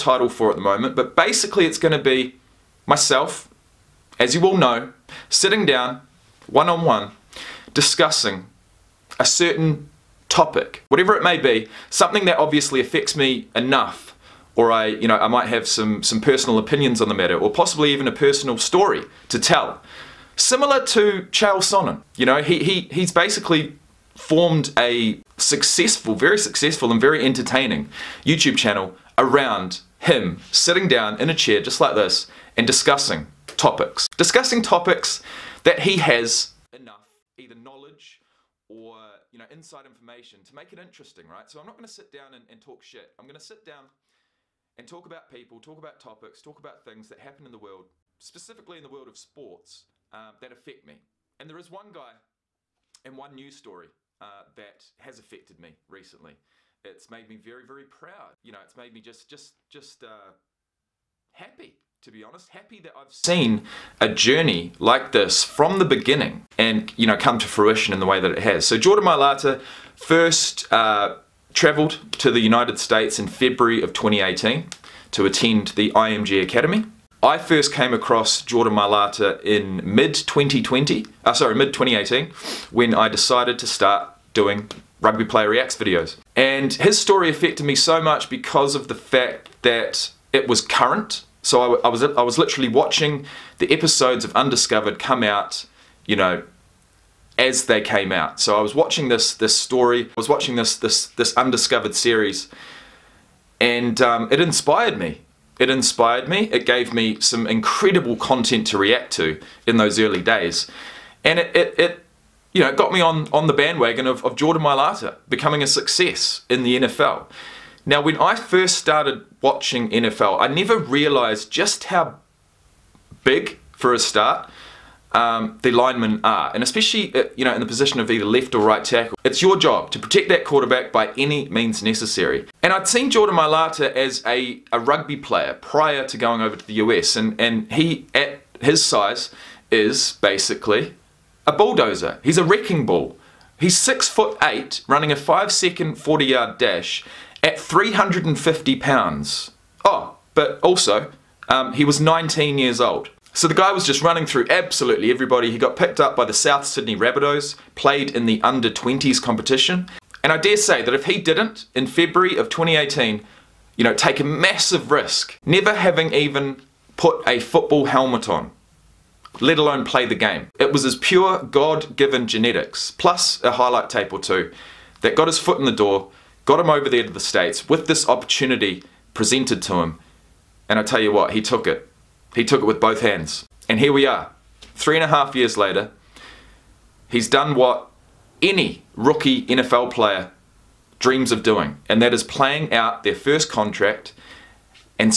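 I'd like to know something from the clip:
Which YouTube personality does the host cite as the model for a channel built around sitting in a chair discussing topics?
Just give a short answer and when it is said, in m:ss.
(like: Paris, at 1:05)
Chael Sonnen, at 0:21.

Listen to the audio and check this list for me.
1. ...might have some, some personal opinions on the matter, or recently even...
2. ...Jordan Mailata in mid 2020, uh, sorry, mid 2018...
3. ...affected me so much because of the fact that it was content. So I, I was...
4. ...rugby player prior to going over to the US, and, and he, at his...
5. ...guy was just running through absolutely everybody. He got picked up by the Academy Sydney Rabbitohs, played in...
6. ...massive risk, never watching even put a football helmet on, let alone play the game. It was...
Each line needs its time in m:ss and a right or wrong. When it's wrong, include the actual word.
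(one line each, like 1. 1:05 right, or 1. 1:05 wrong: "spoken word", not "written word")
1. 0:15 wrong: "possibly", not "recently"
2. 1:18 right
3. 1:27 wrong: "current", not "content"
4. 2:14 right
5. 2:33 wrong: "South", not "Academy"
6. 2:44 wrong: "having", not "watching".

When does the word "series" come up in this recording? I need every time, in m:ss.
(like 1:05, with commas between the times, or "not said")
1:41.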